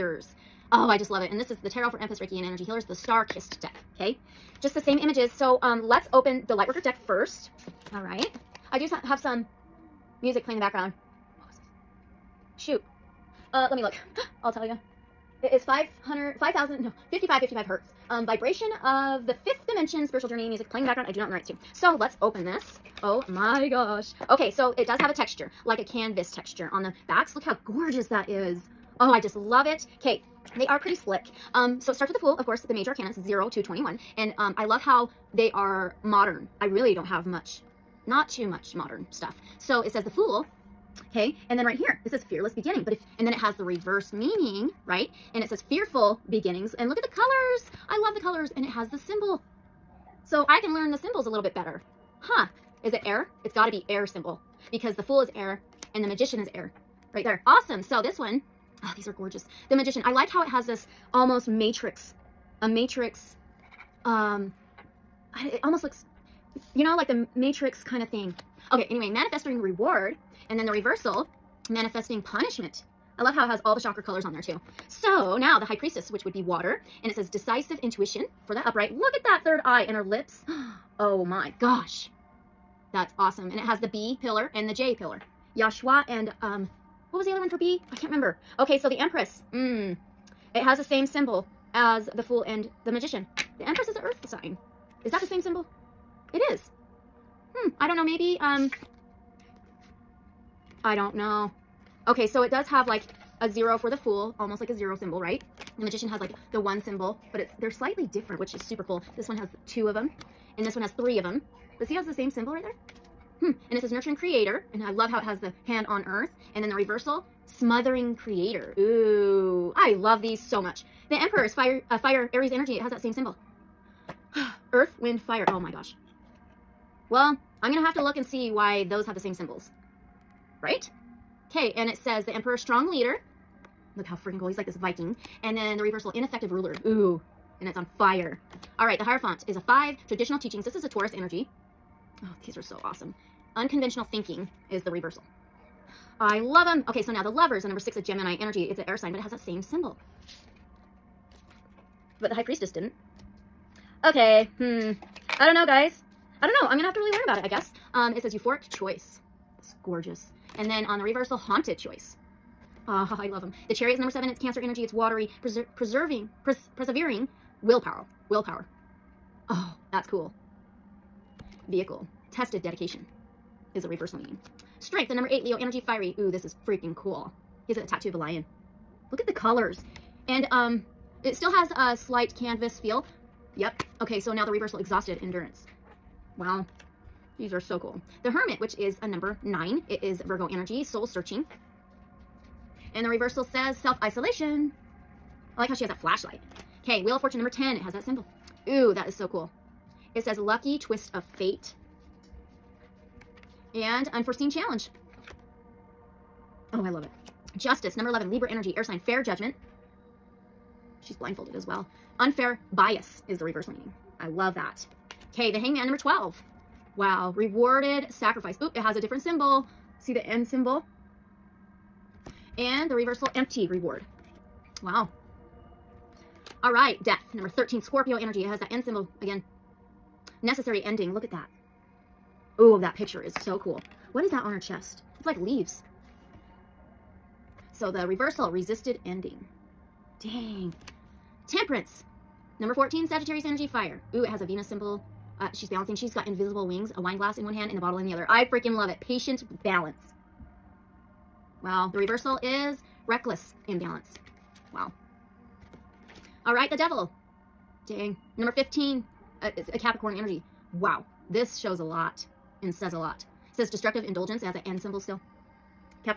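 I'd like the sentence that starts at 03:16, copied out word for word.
Okay, Wheel of Fortune number 10.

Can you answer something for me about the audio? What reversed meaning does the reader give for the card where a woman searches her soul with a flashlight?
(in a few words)
Self-isolation.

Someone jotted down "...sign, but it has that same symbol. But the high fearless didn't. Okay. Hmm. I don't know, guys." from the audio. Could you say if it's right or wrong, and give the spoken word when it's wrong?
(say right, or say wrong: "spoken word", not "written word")
wrong: "priestess", not "fearless".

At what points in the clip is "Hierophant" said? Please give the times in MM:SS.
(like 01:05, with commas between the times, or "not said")
02:19.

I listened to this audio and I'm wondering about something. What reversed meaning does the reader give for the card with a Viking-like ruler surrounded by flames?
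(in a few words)
Ineffective ruler.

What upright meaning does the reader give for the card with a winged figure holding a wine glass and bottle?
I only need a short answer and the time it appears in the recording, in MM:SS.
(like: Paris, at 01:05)
Patient balance, at 04:09.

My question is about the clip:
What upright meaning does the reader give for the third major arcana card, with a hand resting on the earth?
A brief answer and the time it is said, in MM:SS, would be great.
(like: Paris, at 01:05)
Nurturing creator, at 01:53.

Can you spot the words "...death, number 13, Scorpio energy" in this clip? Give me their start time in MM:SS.
03:47.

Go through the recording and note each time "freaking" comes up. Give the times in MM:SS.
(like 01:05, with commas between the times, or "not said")
02:14, 02:56, 04:08.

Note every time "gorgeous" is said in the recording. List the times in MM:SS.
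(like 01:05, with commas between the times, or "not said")
00:27, 00:59, 02:39.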